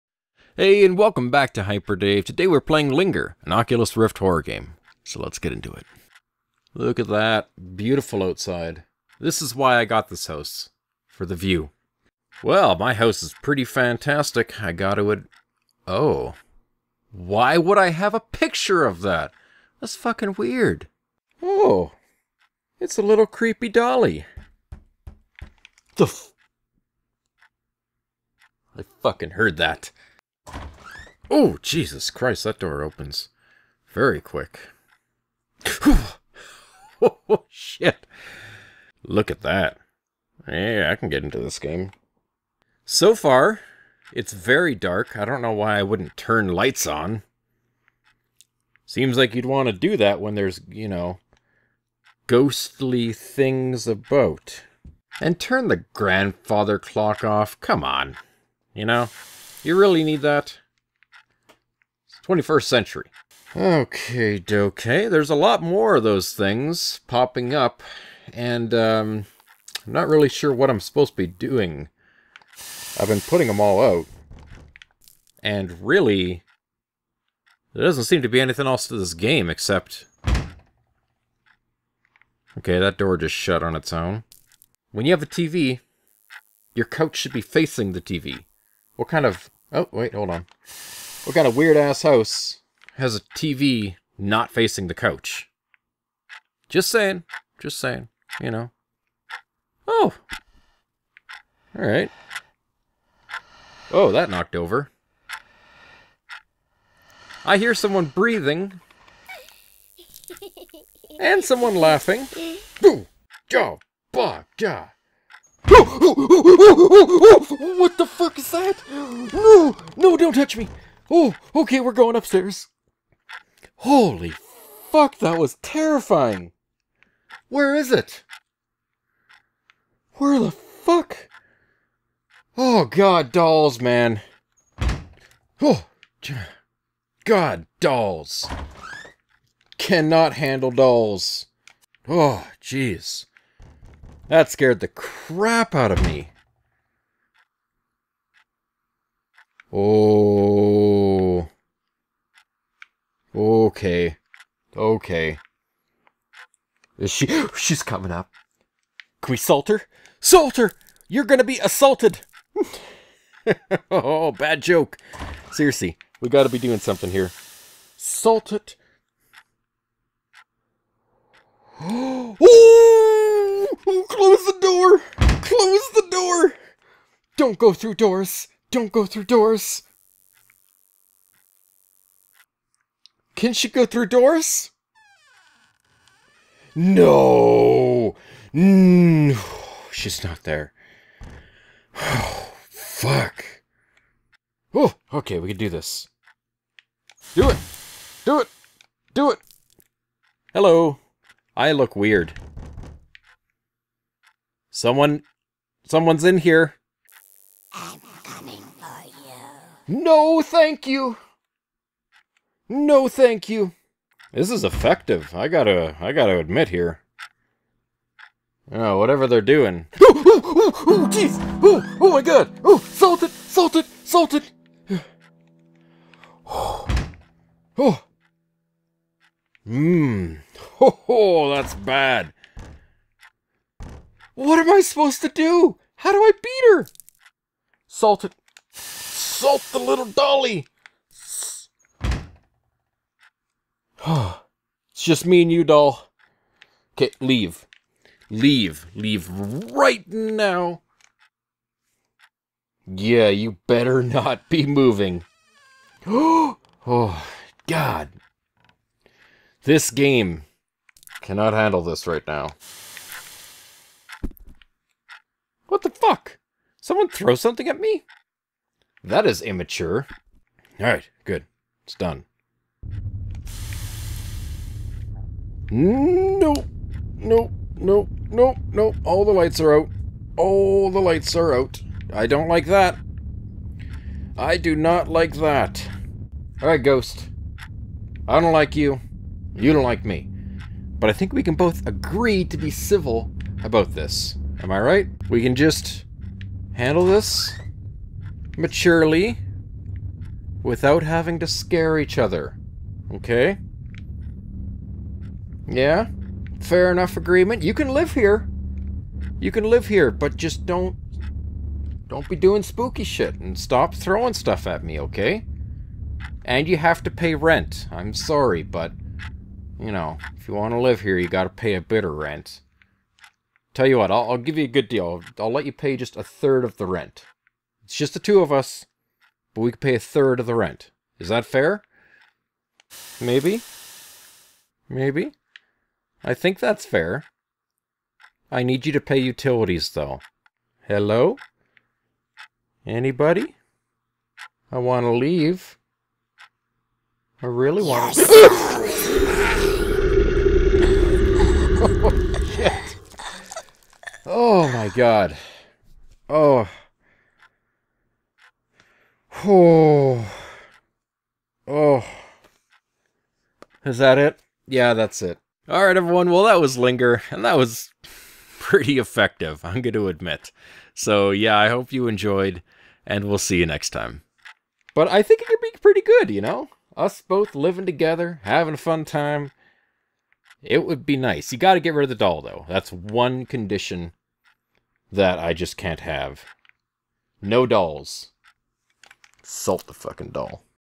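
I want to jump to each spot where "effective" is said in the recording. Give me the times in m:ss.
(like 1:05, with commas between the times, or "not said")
3:34, 6:08.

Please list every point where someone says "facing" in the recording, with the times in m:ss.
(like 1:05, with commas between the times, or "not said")
1:27, 1:34.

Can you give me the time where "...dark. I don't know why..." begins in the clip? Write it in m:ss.
0:44.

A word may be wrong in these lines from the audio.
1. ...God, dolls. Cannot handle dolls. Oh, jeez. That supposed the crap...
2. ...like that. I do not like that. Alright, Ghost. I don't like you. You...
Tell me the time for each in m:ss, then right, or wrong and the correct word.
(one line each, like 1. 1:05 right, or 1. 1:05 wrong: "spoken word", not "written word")
1. 2:17 wrong: "scared", not "supposed"
2. 4:42 right.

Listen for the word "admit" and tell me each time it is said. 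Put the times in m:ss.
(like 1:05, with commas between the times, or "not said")
3:36, 6:10.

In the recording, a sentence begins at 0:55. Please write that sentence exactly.
And turn the grandfather clock off.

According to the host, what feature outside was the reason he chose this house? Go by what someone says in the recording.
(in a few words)
The view.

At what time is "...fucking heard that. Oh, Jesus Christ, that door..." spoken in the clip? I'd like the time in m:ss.
0:29.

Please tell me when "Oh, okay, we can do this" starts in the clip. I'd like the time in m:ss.
3:14.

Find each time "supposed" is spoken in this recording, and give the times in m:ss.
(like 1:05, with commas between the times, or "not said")
1:10, 3:54.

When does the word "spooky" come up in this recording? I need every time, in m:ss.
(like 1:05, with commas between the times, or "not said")
5:12.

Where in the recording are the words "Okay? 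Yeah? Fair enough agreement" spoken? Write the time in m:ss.
5:03.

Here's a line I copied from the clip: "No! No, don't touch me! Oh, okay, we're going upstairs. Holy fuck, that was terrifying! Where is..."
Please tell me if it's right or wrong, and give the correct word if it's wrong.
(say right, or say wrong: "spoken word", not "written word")
right.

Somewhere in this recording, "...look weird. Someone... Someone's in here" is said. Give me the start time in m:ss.
3:21.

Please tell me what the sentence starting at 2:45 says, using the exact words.
Seriously, we gotta be doing something here.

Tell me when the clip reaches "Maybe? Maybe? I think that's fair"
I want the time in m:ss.
5:33.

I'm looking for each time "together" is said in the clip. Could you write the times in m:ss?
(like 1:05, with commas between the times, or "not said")
6:17.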